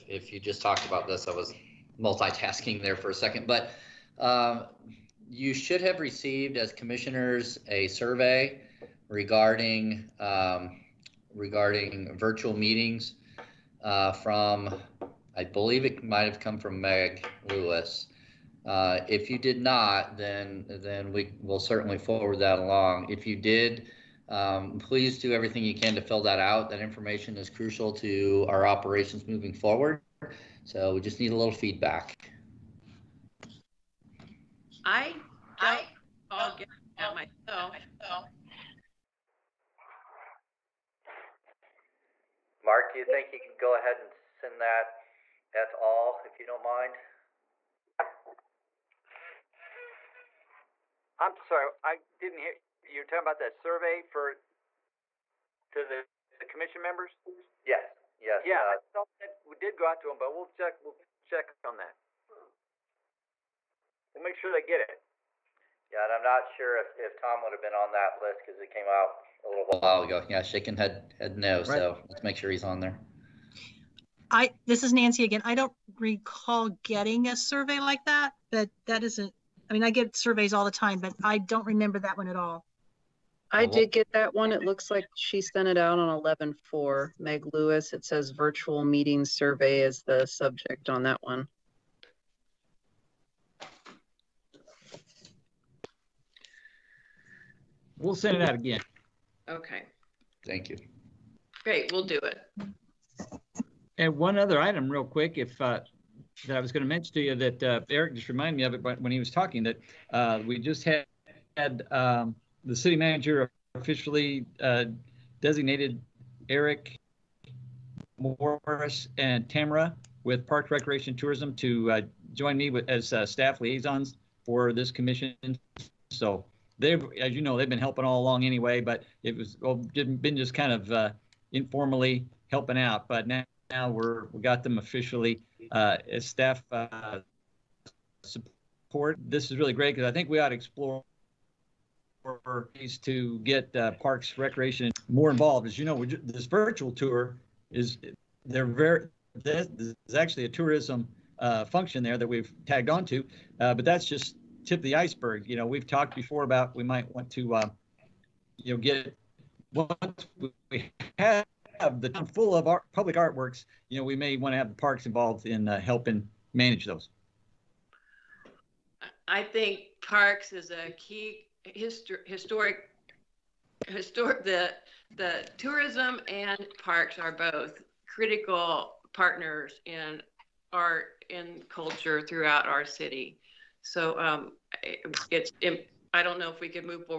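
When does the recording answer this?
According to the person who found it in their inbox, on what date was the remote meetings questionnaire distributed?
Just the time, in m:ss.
1:26.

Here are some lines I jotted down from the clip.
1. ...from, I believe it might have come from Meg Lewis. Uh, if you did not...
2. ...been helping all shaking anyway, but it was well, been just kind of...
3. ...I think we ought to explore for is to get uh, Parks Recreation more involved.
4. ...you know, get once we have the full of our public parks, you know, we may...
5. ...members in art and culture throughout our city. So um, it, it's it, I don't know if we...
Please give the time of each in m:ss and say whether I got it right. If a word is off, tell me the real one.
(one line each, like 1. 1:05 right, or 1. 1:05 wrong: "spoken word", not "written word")
1. 0:14 right
2. 2:07 wrong: "along", not "shaking"
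3. 2:20 right
4. 2:38 wrong: "artworks", not "parks"
5. 2:59 wrong: "partners", not "members".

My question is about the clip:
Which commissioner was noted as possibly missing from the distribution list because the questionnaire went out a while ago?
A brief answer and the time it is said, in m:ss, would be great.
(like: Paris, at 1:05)
Tom, at 1:07.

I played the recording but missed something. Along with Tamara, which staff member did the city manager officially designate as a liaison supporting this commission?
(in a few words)
Eric Morris.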